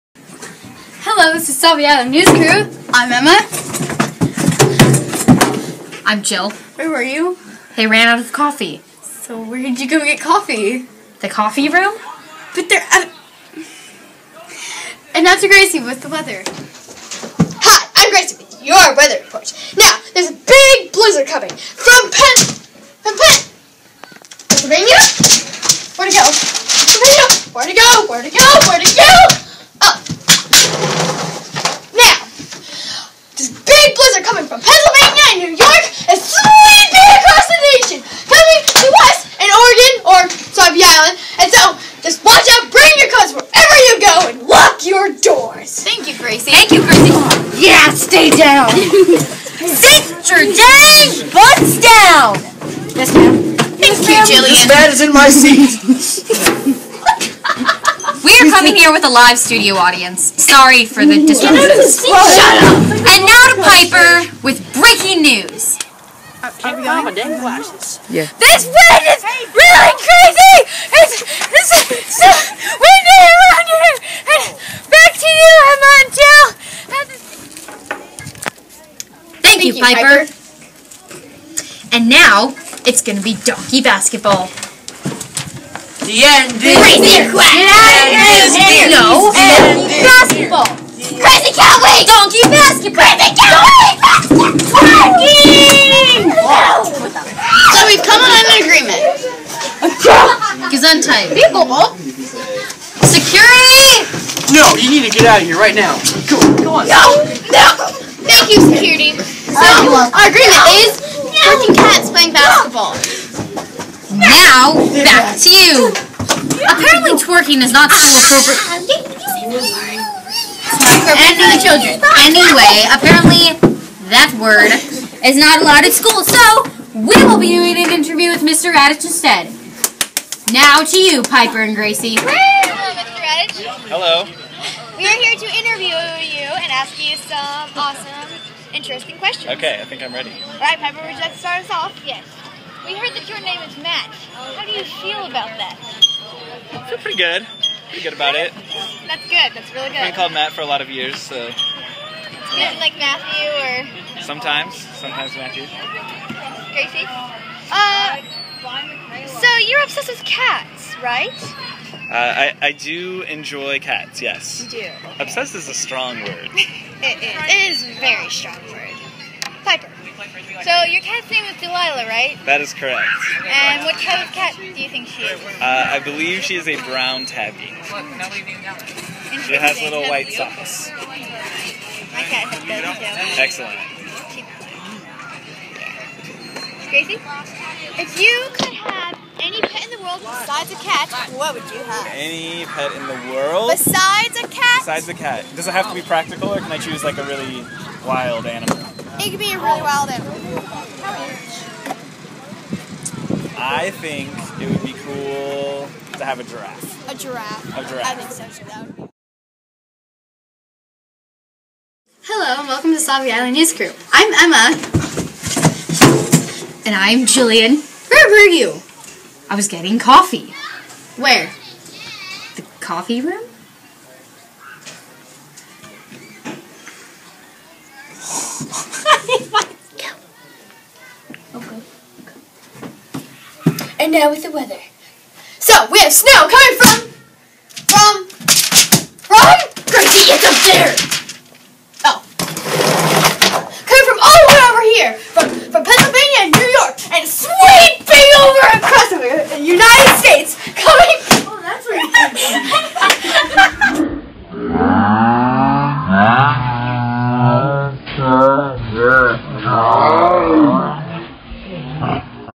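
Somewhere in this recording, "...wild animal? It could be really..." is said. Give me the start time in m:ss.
3:18.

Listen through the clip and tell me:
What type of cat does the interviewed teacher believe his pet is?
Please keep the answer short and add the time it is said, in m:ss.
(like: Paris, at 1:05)
Brown tabby, at 2:56.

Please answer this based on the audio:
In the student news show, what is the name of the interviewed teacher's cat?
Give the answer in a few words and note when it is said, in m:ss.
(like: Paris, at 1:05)
Delilah, at 2:51.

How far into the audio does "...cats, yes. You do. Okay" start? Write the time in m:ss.
2:43.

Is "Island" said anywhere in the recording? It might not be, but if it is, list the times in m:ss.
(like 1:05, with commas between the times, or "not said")
0:40, 3:33.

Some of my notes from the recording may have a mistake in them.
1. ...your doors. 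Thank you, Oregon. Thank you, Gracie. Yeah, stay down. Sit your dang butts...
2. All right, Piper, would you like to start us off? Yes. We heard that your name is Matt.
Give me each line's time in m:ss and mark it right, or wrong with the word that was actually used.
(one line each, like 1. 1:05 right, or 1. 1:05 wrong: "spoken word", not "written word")
1. 0:44 wrong: "Gracie", not "Oregon"
2. 2:20 right.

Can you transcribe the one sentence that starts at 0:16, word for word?
Hi, I'm Gracie with your weather report.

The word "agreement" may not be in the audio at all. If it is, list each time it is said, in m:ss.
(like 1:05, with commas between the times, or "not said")
1:38, 1:50.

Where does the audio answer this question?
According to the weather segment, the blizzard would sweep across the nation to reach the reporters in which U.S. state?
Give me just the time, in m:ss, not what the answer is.
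0:39.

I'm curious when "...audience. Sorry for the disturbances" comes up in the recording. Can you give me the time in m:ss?
0:59.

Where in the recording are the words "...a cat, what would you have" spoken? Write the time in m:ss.
3:10.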